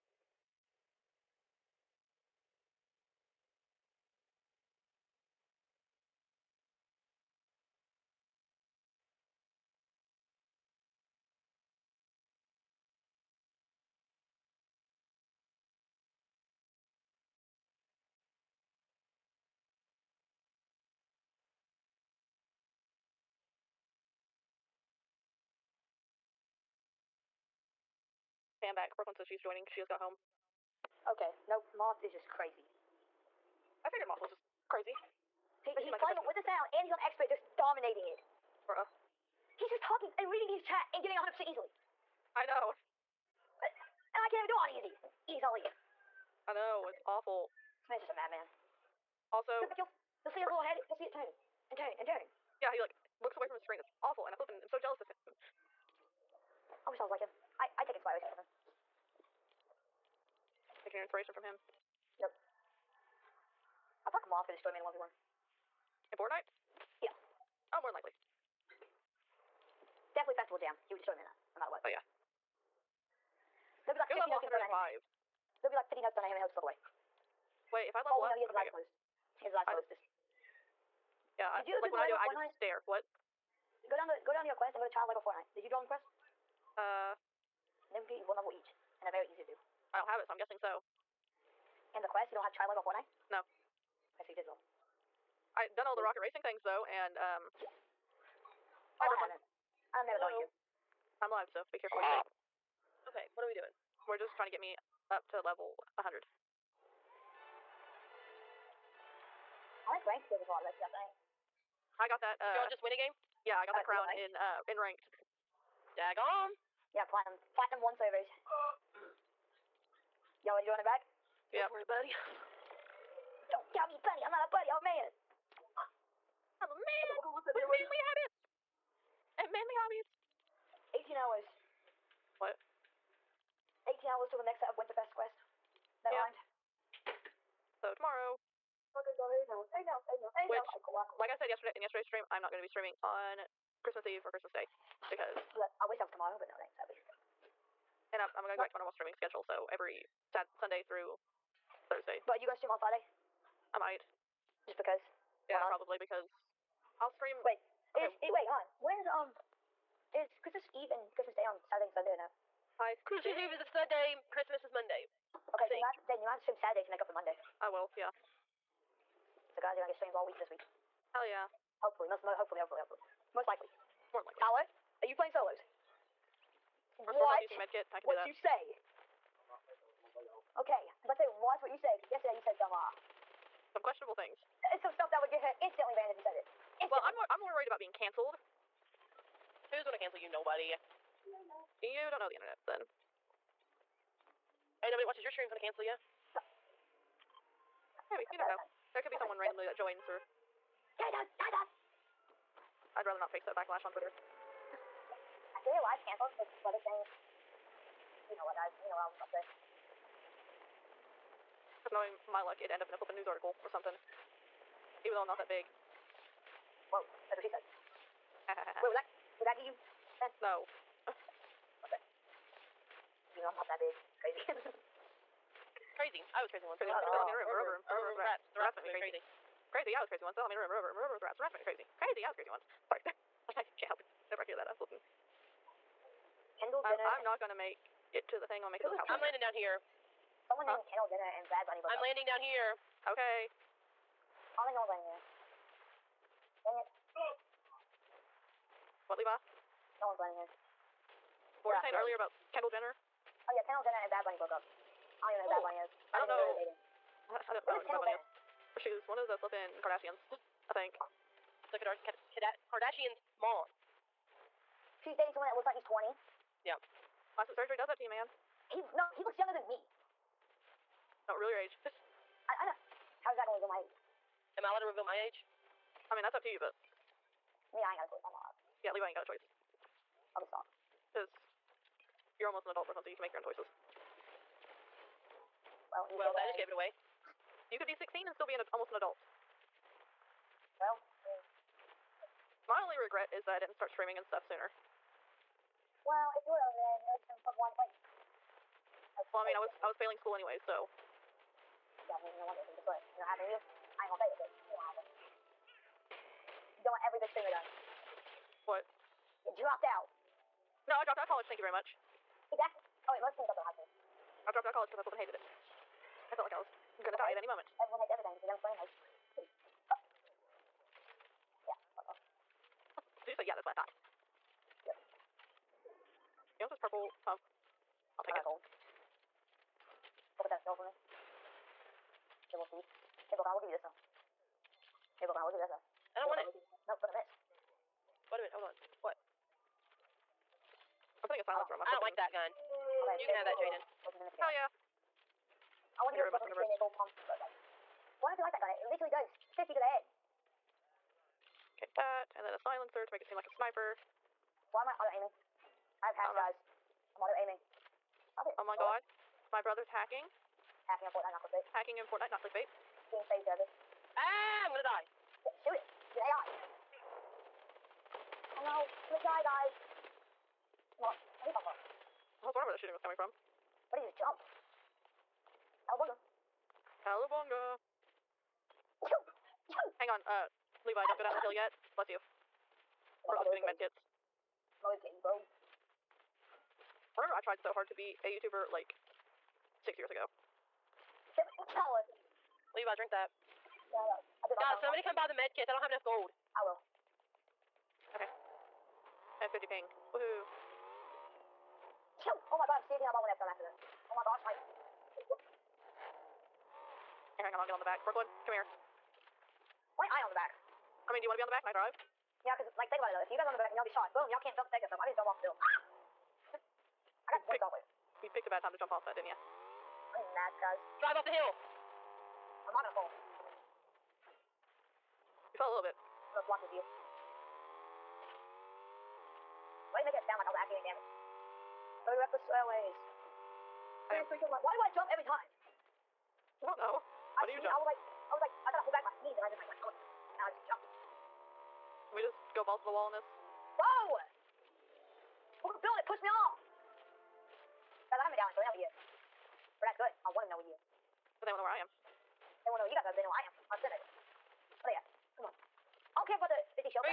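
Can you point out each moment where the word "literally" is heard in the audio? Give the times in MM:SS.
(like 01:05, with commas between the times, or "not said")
05:48.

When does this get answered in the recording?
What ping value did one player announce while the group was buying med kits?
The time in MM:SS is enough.
06:39.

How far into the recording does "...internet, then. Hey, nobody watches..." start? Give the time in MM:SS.
03:12.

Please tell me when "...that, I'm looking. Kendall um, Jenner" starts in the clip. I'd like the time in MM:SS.
03:54.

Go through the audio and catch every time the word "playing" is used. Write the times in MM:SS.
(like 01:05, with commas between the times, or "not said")
00:35, 02:55.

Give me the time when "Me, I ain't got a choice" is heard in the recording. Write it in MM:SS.
04:37.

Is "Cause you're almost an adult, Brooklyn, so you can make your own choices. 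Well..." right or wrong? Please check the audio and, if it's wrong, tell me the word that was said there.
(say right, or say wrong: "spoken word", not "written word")
right.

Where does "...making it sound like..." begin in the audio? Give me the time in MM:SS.
07:10.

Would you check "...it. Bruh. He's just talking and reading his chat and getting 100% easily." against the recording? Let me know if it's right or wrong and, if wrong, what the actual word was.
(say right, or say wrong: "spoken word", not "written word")
right.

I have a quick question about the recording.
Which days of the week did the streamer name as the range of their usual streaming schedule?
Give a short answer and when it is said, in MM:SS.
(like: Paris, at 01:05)
Sunday through Thursday, at 02:30.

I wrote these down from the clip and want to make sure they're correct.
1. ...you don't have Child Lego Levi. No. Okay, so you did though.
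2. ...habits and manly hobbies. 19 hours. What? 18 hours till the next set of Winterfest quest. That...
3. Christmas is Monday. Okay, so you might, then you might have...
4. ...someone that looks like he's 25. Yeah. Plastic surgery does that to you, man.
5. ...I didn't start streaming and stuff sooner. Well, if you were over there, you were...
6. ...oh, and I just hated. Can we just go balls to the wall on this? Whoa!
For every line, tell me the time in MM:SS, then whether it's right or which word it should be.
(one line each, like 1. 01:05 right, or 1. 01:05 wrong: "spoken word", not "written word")
1. 01:32 wrong: "Fortnite", not "Levi"
2. 02:08 wrong: "18", not "19"
3. 02:44 right
4. 04:25 wrong: "20", not "25"
5. 04:53 right
6. 07:19 wrong: "jumped", not "hated".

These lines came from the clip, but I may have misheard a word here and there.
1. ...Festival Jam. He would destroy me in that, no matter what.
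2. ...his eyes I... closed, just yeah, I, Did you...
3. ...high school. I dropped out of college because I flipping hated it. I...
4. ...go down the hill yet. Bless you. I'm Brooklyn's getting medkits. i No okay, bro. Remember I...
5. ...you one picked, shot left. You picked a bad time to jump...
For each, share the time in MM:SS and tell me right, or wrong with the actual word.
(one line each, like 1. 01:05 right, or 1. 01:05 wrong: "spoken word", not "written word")
1. 01:10 right
2. 01:19 right
3. 05:13 right
4. 06:21 right
5. 06:57 right.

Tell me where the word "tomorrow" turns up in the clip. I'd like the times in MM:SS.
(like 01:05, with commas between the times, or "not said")
02:17, 02:26.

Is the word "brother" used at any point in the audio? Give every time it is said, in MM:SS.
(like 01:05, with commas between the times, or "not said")
03:26, 05:59.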